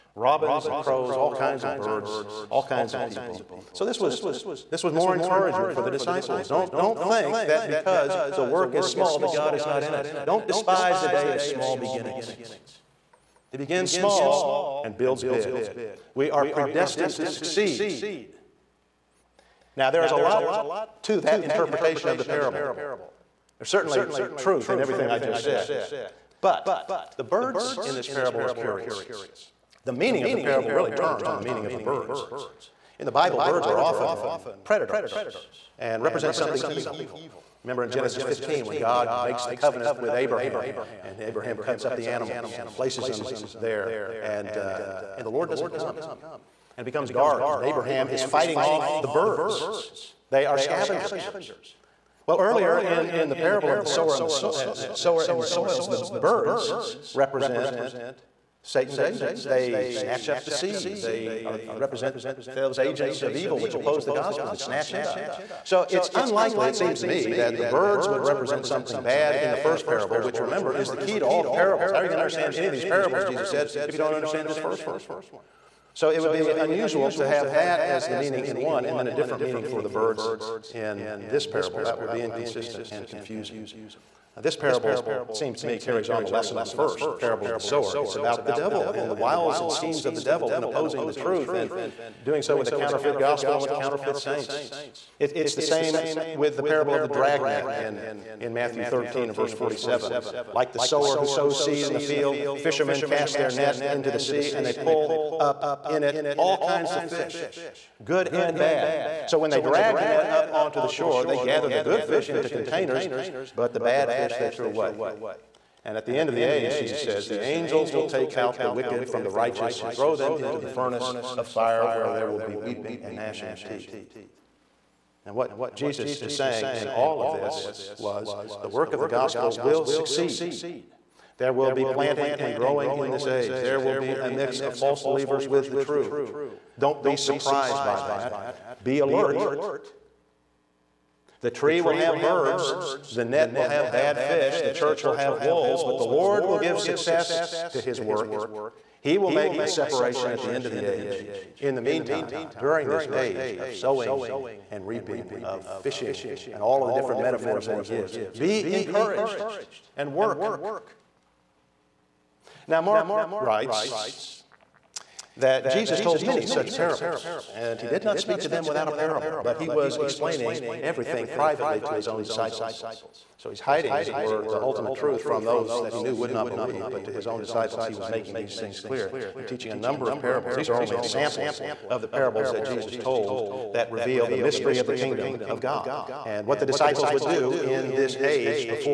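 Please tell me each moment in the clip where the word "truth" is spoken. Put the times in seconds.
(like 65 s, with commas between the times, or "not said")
24 s, 91 s, 174 s.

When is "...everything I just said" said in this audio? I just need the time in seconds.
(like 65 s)
24 s.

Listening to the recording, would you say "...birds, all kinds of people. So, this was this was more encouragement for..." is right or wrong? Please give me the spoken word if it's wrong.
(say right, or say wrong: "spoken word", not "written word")
right.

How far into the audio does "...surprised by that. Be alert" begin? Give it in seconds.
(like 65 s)
137 s.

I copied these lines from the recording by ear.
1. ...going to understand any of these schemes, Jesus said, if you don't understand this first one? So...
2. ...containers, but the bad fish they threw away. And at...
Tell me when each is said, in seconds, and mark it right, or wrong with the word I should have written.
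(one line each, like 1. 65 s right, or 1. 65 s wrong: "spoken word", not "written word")
1. 72 s wrong: "parables", not "schemes"
2. 112 s right.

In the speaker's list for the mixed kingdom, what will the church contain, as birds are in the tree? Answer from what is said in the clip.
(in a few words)
Wolves.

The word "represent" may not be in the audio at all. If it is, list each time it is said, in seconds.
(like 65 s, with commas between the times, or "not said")
36 s, 57 s, 61 s, 68 s.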